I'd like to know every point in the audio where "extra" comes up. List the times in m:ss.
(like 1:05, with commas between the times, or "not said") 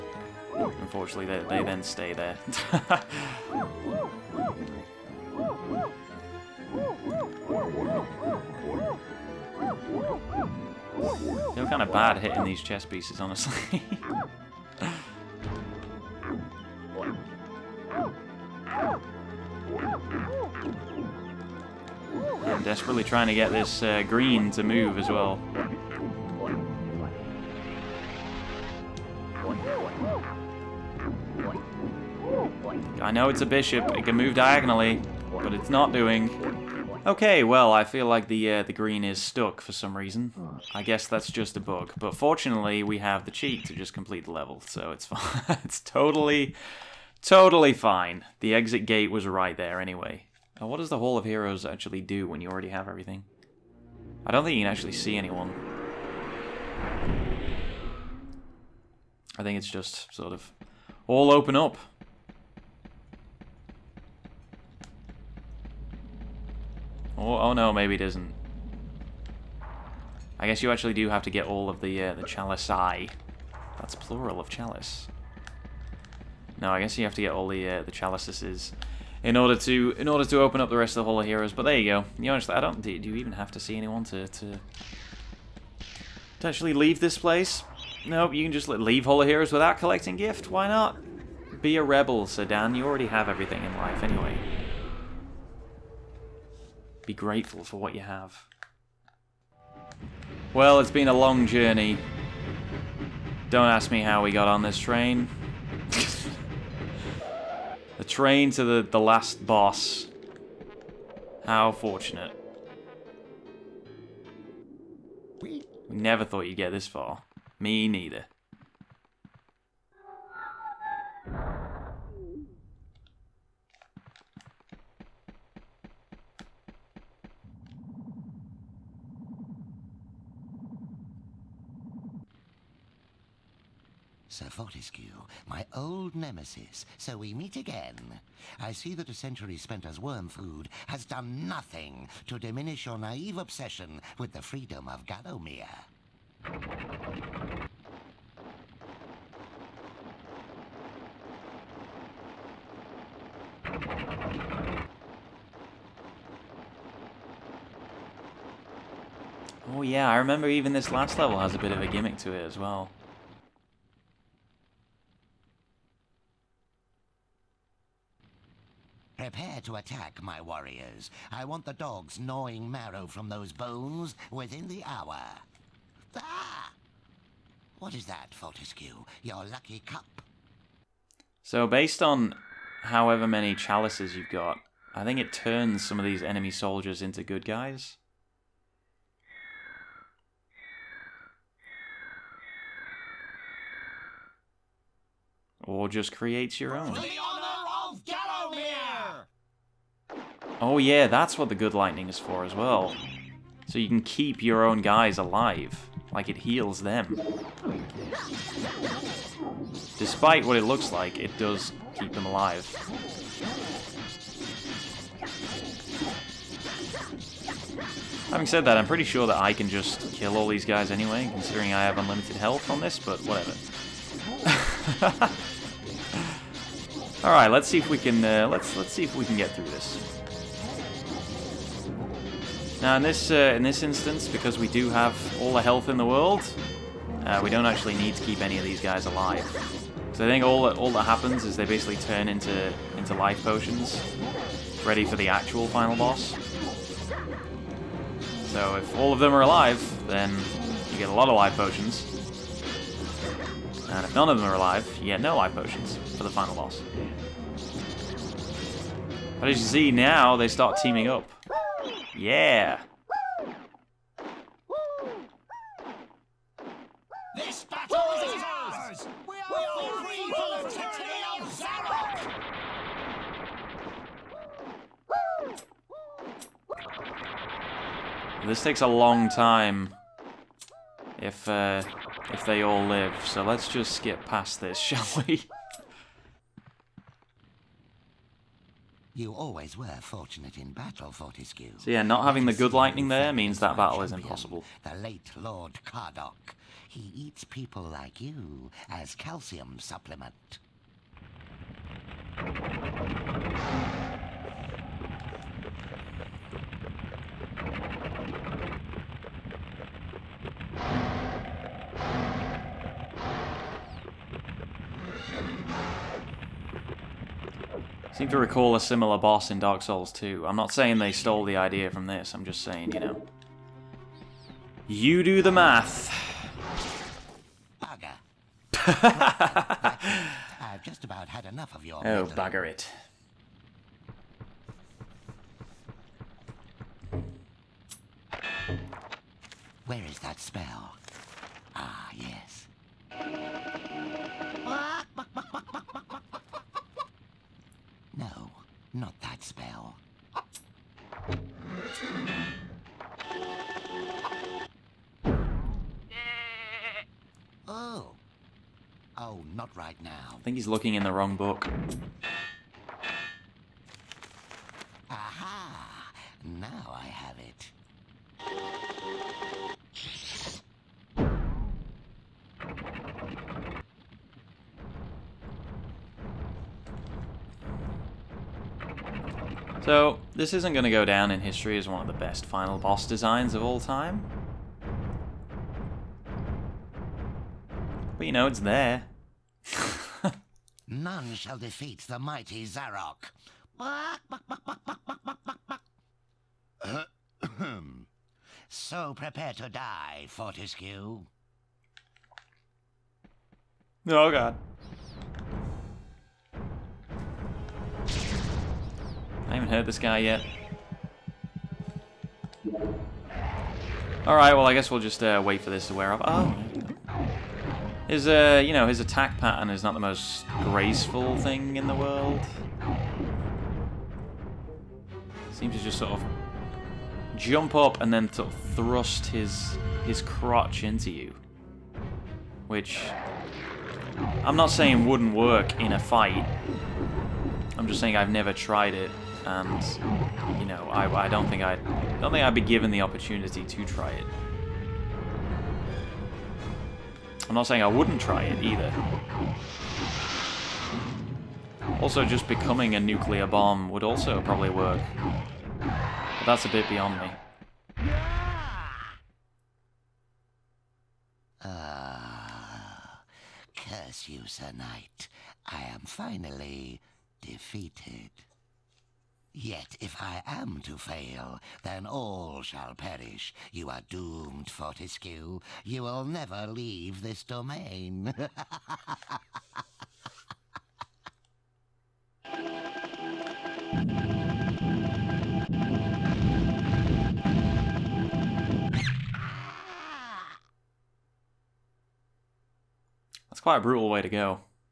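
not said.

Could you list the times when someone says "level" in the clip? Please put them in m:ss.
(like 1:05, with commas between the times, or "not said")
0:44, 2:41.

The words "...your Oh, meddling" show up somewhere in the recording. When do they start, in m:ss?
5:31.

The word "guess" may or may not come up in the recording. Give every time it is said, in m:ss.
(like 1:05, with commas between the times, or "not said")
0:40, 1:10, 1:16, 6:54.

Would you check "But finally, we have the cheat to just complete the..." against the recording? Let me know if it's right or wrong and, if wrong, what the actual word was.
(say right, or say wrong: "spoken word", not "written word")
wrong: "fortunately", not "finally".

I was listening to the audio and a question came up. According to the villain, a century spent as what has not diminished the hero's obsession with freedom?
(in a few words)
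Worm food.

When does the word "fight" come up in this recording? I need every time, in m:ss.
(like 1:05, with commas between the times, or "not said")
7:15.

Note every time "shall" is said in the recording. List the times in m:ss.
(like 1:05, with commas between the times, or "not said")
4:44, 6:31.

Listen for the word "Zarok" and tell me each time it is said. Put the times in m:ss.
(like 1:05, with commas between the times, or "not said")
4:31, 6:32.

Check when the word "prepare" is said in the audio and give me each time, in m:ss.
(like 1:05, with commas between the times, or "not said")
2:49, 6:39.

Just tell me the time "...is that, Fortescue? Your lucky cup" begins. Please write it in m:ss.
2:57.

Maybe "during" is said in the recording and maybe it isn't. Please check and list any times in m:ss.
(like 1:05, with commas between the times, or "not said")
not said.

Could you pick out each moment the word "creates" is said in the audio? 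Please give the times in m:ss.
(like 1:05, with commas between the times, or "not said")
3:16.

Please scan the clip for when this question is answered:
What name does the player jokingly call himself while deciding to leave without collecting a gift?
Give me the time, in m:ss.
1:32.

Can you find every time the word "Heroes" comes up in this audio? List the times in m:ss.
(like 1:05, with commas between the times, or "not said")
0:51, 1:21, 1:29.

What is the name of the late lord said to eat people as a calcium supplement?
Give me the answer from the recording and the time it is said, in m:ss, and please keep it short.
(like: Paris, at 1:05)
Lord Kardok, at 4:55.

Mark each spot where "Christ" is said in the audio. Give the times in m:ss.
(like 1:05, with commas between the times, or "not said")
not said.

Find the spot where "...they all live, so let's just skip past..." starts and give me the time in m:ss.
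4:42.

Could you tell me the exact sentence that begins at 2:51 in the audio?
I want the dogs gnawing marrow from those bones within the hour.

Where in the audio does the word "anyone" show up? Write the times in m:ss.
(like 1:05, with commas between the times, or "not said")
0:55, 1:23.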